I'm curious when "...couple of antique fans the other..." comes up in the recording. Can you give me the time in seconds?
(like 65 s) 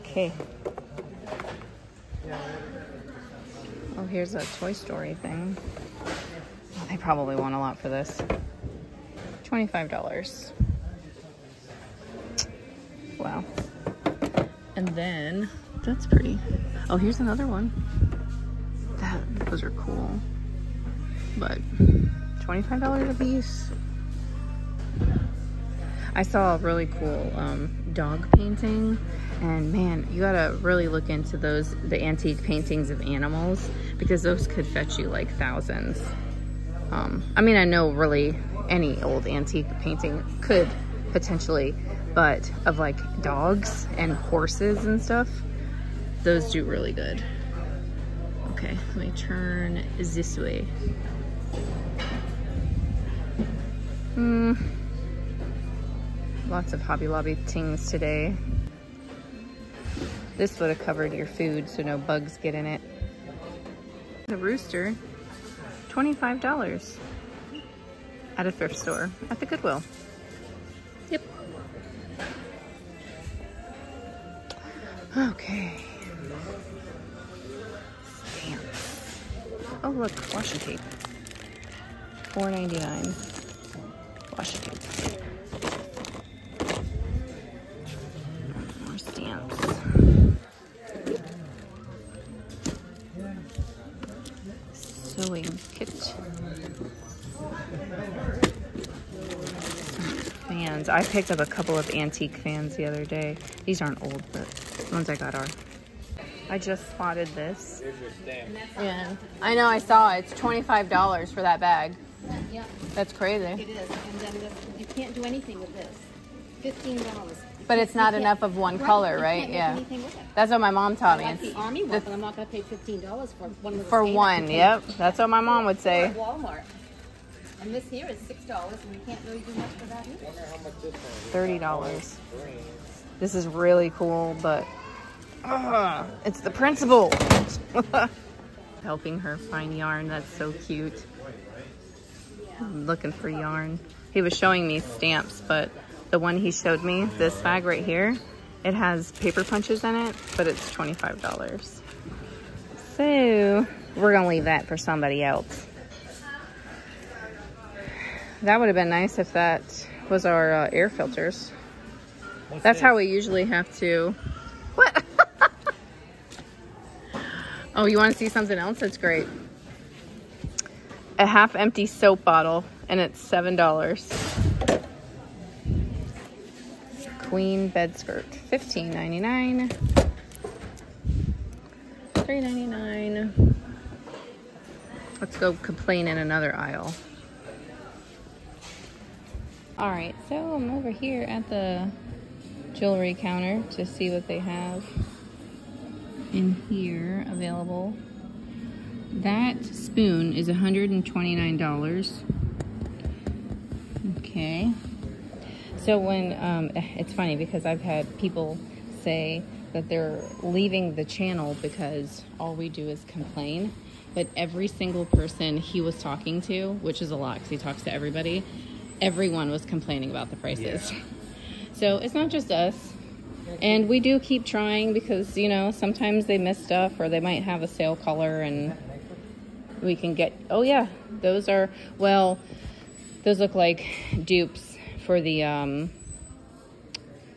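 101 s.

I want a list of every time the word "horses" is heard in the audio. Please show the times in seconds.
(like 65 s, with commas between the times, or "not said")
44 s.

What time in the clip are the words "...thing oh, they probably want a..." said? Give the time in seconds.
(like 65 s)
5 s.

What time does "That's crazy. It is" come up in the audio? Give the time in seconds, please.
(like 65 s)
112 s.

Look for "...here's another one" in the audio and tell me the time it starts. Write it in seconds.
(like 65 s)
16 s.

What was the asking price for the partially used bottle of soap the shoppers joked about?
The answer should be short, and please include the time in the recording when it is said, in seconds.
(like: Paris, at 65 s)
$7, at 173 s.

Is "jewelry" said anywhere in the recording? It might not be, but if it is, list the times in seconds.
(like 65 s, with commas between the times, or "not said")
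192 s.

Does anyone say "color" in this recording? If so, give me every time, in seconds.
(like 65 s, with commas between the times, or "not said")
118 s, 227 s.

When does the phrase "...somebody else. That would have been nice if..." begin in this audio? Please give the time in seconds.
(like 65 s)
154 s.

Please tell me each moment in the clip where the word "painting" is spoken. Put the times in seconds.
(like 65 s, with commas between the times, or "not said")
28 s, 32 s, 39 s.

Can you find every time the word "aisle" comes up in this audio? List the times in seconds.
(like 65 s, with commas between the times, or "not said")
186 s.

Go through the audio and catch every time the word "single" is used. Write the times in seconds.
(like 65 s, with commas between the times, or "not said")
214 s.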